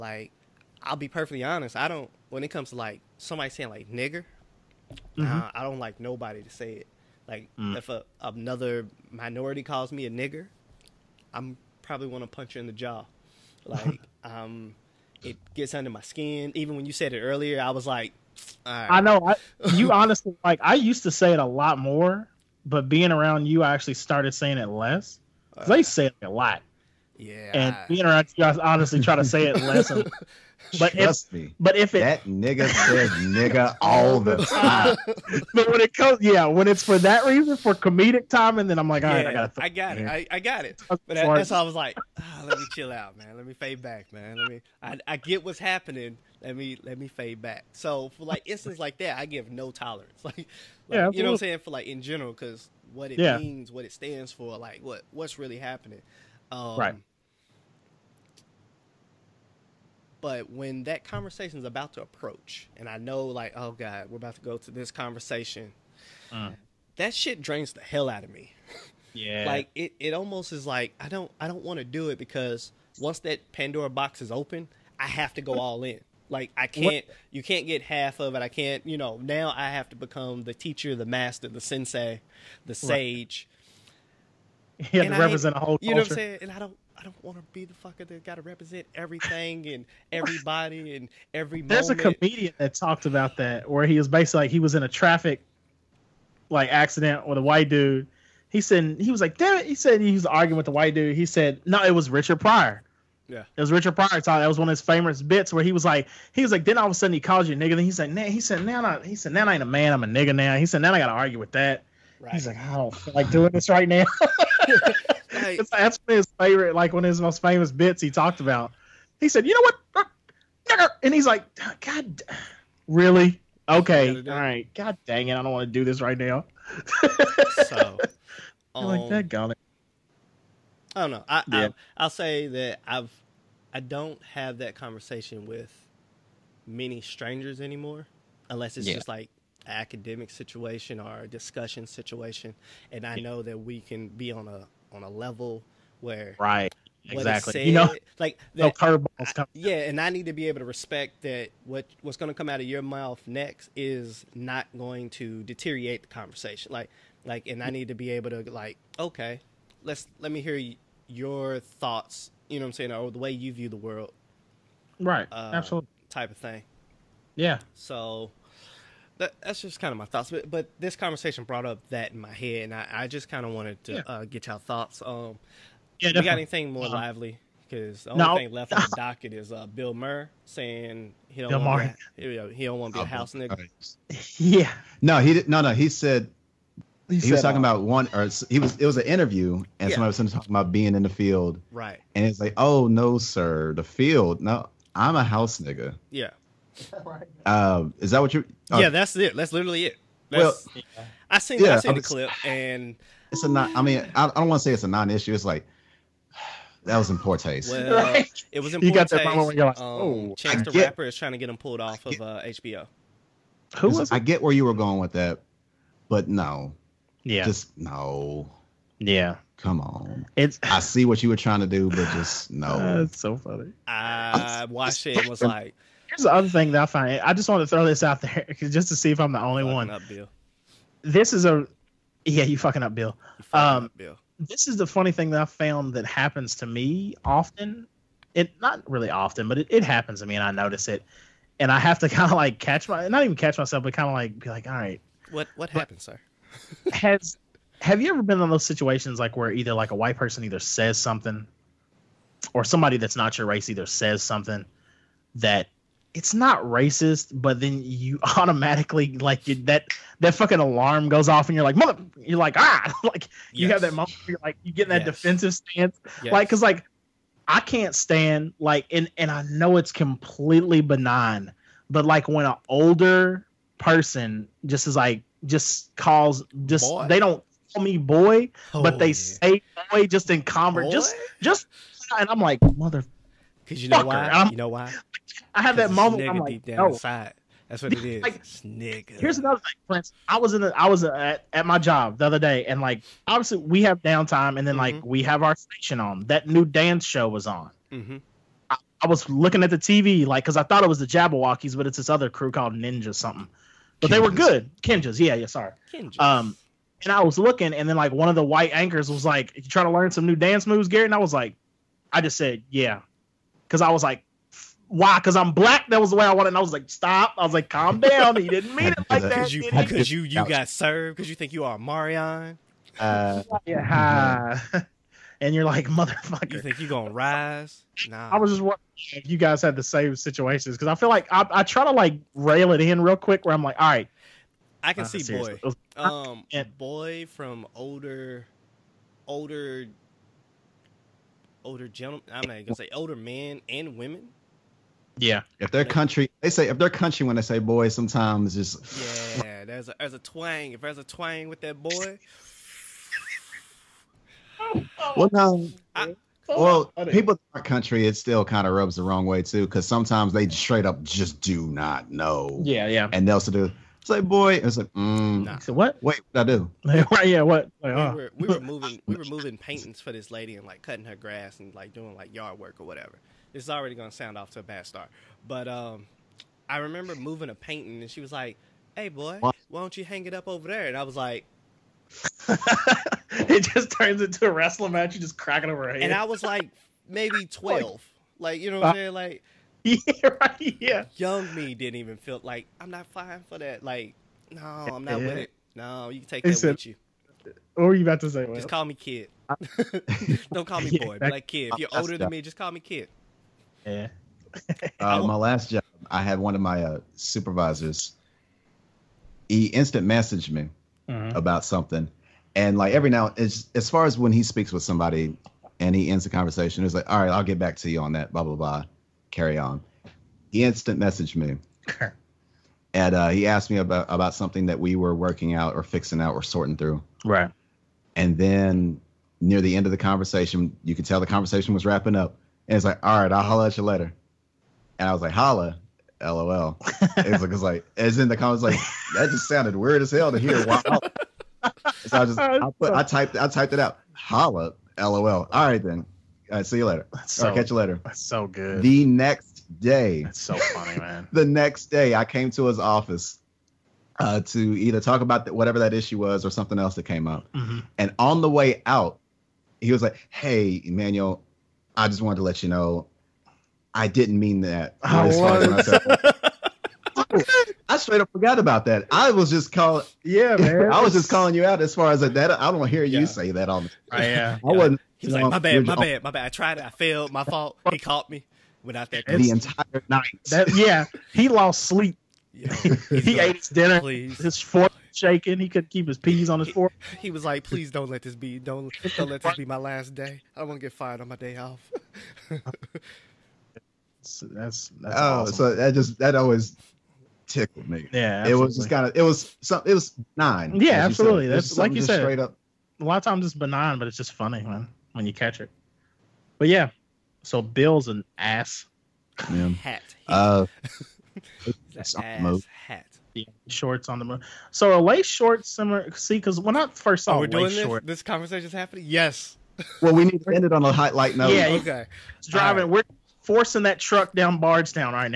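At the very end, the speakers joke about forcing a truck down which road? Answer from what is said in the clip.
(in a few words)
Bardstown.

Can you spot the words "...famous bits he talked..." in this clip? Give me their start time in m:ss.
1:57.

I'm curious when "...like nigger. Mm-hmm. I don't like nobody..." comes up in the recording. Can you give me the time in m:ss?
0:03.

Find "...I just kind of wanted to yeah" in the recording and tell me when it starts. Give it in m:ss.
2:52.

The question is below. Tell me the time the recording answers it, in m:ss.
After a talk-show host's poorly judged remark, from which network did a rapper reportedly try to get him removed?
3:32.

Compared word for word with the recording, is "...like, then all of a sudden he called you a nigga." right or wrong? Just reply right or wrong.
right.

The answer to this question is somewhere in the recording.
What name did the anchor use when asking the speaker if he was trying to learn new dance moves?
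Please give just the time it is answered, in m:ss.
5:10.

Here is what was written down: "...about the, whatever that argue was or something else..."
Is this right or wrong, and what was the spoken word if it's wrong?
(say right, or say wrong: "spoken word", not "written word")
wrong: "issue", not "argue".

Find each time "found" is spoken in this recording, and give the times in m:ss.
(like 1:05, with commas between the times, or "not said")
3:55.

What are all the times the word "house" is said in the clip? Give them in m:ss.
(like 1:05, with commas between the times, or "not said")
3:03, 3:15.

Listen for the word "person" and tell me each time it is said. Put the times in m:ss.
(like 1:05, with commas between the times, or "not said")
4:10, 4:33.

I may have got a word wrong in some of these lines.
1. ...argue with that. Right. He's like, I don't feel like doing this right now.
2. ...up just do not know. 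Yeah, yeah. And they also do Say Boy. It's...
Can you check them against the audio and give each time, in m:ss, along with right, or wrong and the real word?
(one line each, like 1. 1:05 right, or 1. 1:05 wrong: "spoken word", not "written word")
1. 1:51 right
2. 6:00 right.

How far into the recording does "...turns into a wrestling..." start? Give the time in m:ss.
6:23.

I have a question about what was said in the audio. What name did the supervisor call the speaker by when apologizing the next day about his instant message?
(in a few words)
Emmanuel.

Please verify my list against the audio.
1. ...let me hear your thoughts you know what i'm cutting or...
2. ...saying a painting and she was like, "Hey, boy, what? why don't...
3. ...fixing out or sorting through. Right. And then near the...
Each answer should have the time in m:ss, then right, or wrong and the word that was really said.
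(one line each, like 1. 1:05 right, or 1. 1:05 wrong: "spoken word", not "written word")
1. 2:40 wrong: "saying", not "cutting"
2. 6:17 wrong: "moving", not "saying"
3. 7:05 right.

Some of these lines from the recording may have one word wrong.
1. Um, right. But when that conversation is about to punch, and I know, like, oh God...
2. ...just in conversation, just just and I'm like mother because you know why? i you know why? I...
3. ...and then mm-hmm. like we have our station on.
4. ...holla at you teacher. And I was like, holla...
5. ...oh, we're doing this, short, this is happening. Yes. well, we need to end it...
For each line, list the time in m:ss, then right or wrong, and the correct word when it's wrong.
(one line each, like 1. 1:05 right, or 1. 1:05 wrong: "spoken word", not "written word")
1. 0:56 wrong: "approach", not "punch"
2. 4:40 right
3. 4:54 right
4. 7:13 wrong: "later", not "teacher"
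5. 8:37 right.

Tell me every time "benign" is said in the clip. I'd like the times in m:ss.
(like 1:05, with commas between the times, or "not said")
4:30, 8:23.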